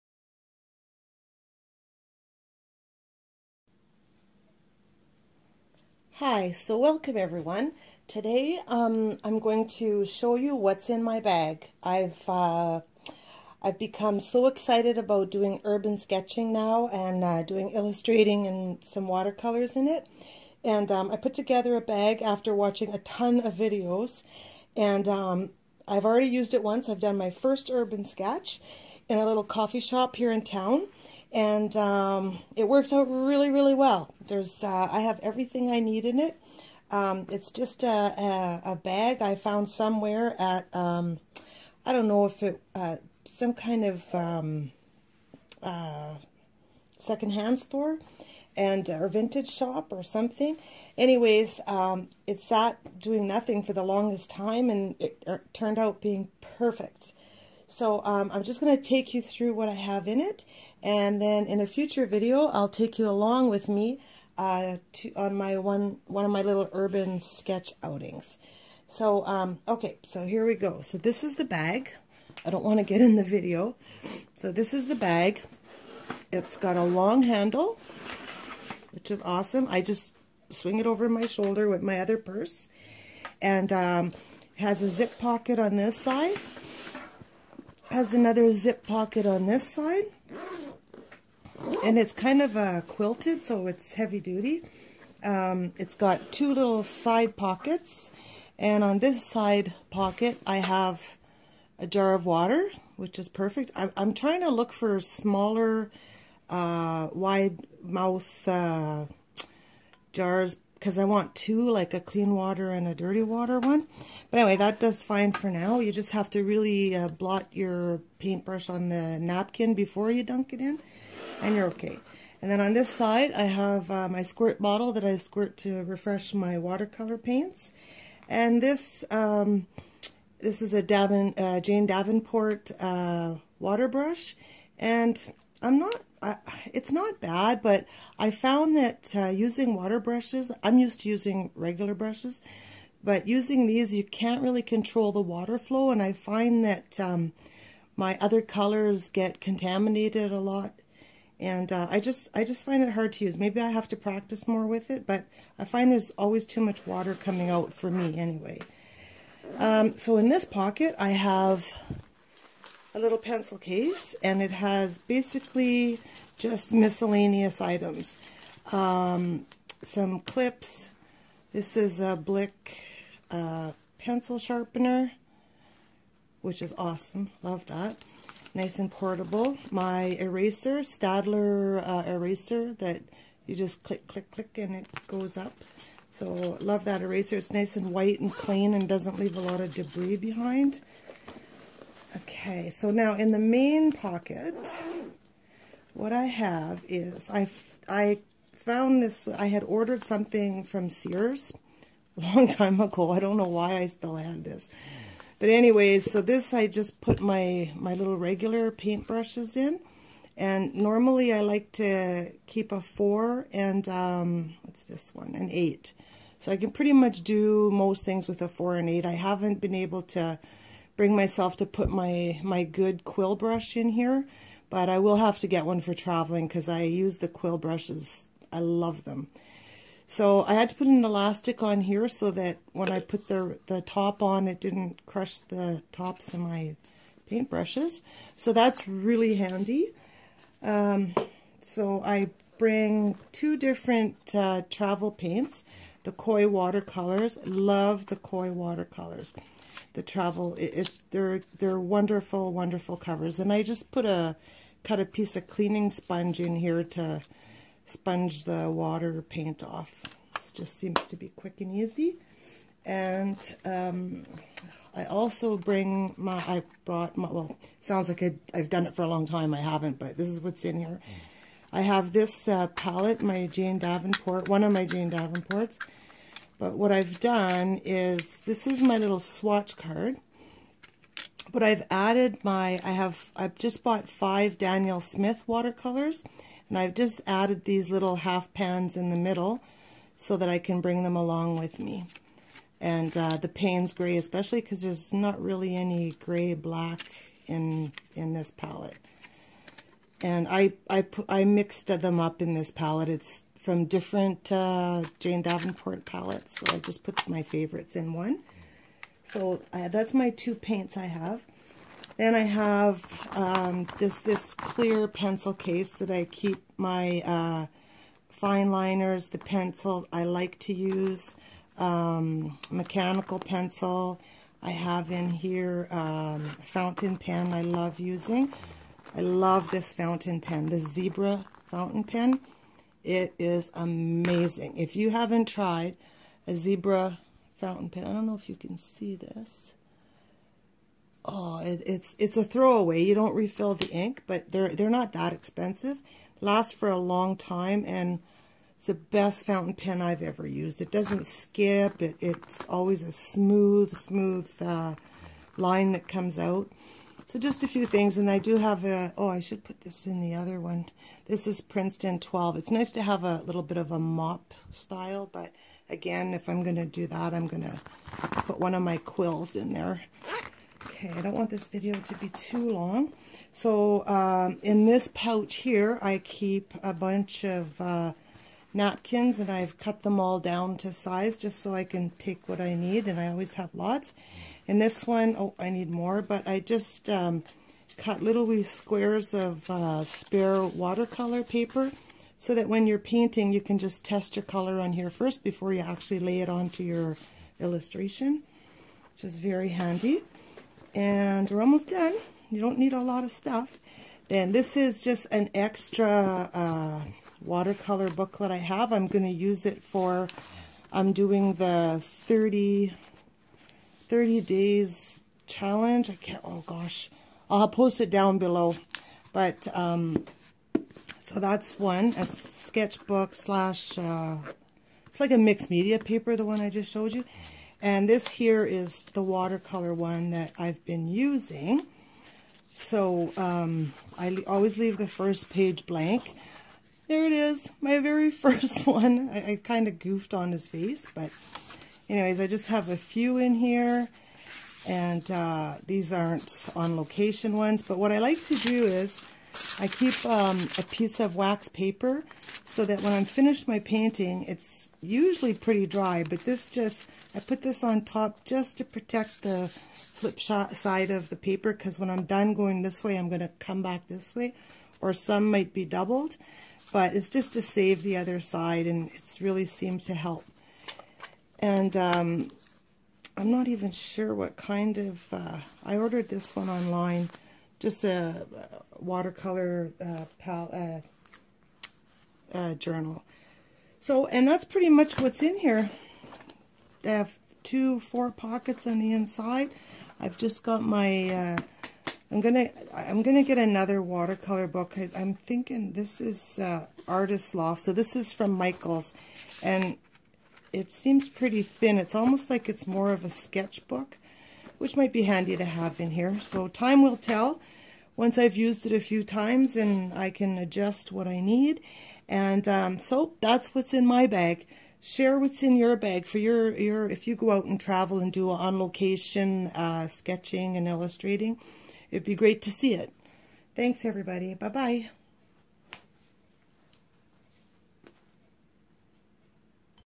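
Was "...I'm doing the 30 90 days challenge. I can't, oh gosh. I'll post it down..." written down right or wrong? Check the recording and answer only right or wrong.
wrong.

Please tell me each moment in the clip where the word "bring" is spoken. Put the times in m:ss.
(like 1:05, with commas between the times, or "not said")
3:41, 4:02, 4:25, 4:50.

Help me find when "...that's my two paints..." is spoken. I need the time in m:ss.
5:09.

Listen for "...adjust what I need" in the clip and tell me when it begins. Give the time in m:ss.
8:30.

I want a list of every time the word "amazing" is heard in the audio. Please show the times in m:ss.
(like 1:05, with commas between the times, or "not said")
5:33.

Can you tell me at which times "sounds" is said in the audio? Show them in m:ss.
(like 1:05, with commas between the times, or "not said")
4:27.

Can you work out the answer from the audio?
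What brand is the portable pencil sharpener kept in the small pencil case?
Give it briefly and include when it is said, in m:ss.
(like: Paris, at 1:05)
Blick, at 2:52.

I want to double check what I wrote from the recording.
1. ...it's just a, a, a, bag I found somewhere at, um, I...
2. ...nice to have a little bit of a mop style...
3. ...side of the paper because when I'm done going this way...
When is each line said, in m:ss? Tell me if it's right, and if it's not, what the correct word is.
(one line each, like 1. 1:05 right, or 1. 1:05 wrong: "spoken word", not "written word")
1. 0:37 right
2. 6:02 right
3. 7:40 right.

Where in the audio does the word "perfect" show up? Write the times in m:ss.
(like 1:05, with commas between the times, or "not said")
0:56, 1:43.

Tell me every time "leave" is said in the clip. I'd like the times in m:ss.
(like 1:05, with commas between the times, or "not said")
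3:09, 7:14.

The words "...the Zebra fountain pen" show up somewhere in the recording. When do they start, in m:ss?
5:30.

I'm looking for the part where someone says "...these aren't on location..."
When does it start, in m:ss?
7:25.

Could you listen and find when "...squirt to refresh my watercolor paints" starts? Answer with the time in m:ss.
2:05.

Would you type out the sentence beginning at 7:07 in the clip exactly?
And this here is the watercolor one that I've been using.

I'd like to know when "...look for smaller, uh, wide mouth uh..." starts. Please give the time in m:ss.
1:44.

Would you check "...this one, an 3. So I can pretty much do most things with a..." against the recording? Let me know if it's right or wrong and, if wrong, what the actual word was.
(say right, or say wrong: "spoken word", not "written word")
wrong: "8", not "3".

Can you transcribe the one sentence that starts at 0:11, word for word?
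I've uh, I've become so excited about doing urban sketching now and uh, doing illustrating and some watercolors in it.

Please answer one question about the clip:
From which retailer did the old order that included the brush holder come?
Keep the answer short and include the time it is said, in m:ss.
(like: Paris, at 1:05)
Sears, at 3:20.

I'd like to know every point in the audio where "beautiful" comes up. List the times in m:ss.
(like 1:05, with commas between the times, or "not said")
not said.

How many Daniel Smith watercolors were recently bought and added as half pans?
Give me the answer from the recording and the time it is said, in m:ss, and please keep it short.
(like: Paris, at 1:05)
5, at 4:44.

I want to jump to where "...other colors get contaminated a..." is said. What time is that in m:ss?
2:28.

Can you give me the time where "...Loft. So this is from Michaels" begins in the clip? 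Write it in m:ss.
8:17.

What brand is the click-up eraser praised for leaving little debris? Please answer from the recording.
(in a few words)
Staedtler.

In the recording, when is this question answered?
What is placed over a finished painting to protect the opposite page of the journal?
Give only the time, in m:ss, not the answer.
7:31.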